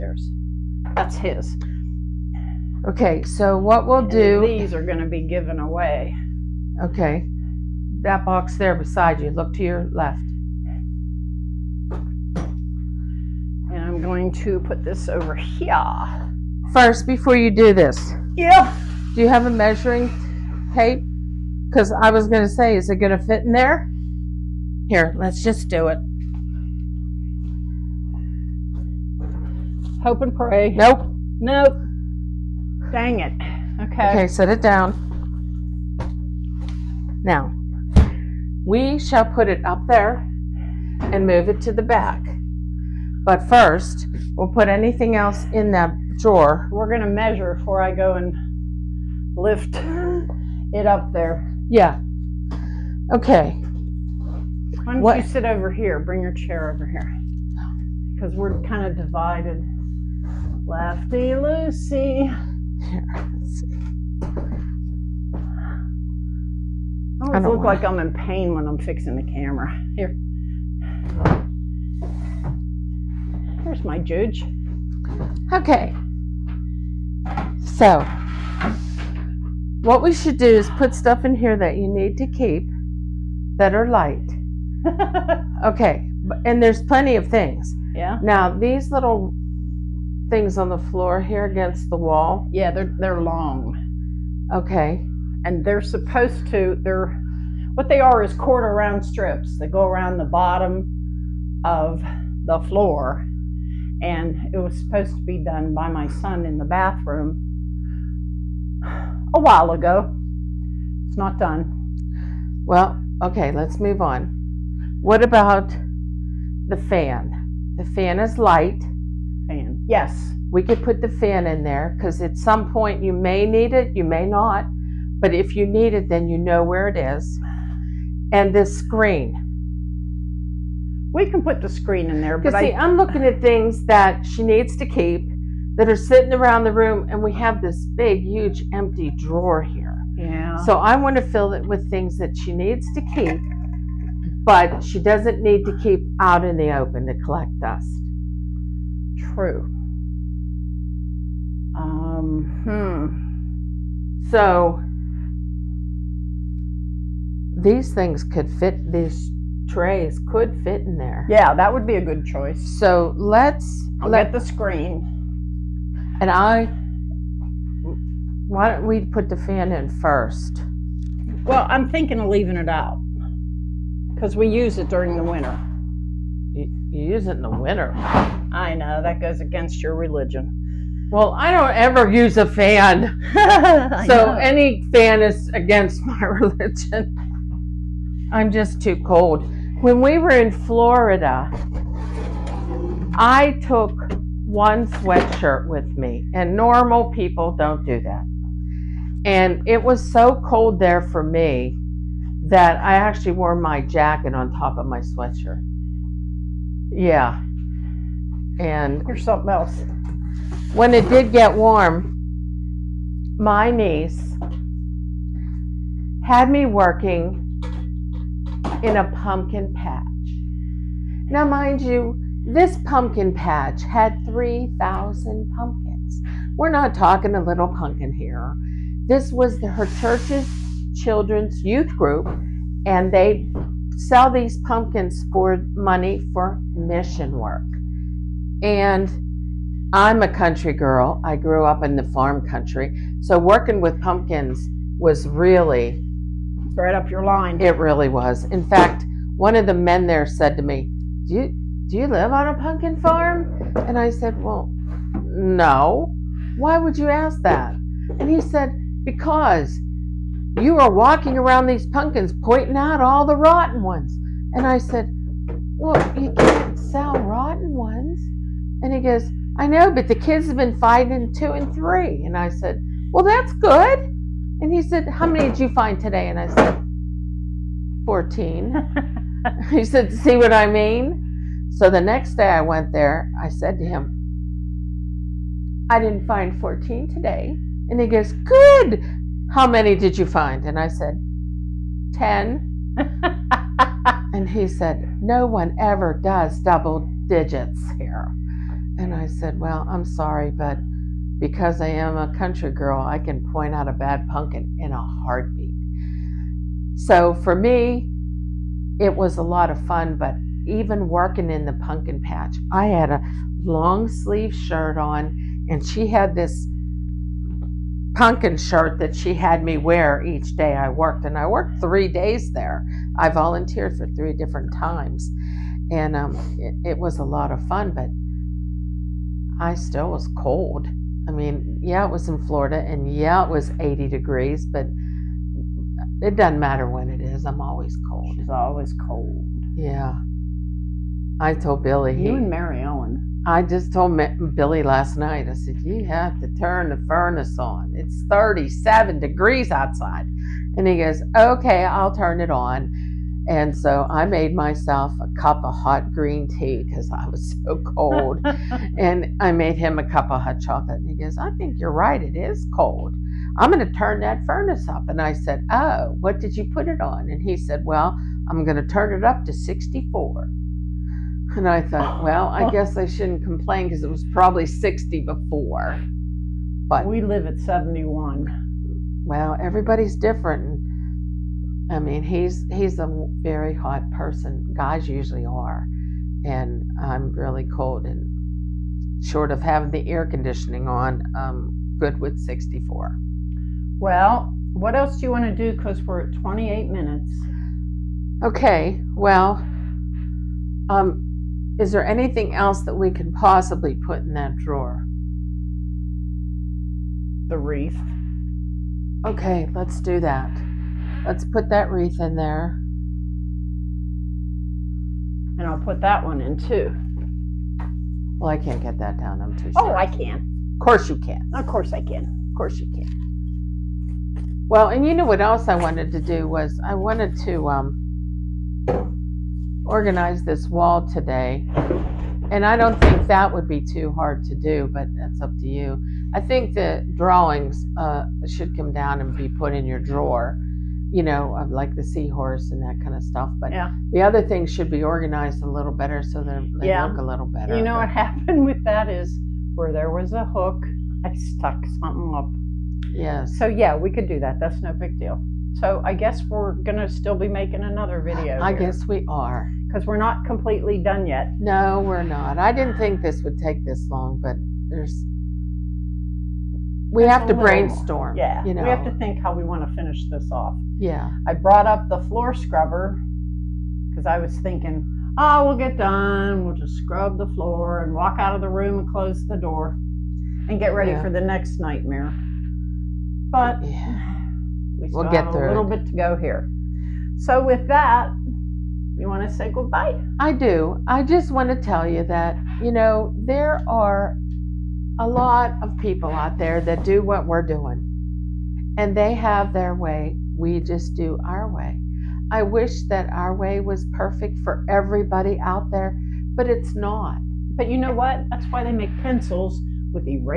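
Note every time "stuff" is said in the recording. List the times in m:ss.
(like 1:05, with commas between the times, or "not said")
1:20, 7:23.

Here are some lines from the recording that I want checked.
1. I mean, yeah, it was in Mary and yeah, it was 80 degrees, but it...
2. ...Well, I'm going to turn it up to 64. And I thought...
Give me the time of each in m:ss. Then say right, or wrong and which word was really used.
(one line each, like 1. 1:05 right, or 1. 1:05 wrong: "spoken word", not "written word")
1. 5:31 wrong: "Florida", not "Mary"
2. 6:07 right.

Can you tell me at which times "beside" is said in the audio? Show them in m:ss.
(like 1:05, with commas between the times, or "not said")
0:08.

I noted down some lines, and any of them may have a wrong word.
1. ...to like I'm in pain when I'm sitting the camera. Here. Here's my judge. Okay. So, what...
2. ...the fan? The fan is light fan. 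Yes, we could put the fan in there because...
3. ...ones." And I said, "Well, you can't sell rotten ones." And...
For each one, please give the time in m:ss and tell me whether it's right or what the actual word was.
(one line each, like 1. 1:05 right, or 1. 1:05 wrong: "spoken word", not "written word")
1. 1:07 wrong: "fixing", not "sitting"
2. 1:56 right
3. 4:23 right.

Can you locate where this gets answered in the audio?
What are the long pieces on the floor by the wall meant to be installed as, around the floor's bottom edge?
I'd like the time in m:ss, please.
1:38.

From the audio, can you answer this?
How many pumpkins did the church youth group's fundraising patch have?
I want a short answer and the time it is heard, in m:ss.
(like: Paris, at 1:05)
3,000, at 3:44.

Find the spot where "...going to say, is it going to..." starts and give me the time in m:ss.
0:22.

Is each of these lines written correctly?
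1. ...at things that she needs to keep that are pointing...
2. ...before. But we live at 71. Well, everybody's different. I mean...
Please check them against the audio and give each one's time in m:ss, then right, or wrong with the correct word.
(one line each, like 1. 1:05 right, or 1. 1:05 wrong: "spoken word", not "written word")
1. 2:13 wrong: "sitting", not "pointing"
2. 6:15 right.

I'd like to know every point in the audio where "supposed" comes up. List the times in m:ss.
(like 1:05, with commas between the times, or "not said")
1:35, 1:44.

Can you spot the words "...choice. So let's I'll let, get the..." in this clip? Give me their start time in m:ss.
2:42.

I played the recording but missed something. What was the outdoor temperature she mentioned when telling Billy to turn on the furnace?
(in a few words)
37 degrees.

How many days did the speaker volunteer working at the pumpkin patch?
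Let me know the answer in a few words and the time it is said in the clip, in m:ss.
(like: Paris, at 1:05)
three days, at 5:21.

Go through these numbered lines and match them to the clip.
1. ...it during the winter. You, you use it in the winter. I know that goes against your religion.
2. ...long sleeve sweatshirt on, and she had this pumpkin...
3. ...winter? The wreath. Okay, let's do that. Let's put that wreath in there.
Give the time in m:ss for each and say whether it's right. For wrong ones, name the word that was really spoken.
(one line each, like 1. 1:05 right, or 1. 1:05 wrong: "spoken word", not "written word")
1. 2:54 right
2. 5:13 wrong: "shirt", not "sweatshirt"
3. 6:44 wrong: "drawer", not "winter".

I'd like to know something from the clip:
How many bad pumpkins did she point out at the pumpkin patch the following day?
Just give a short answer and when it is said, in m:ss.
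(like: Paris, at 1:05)
10, at 4:52.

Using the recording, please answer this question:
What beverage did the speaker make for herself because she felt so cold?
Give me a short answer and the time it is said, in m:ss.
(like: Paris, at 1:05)
hot green tea, at 5:55.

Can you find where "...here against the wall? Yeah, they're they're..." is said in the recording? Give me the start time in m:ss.
1:31.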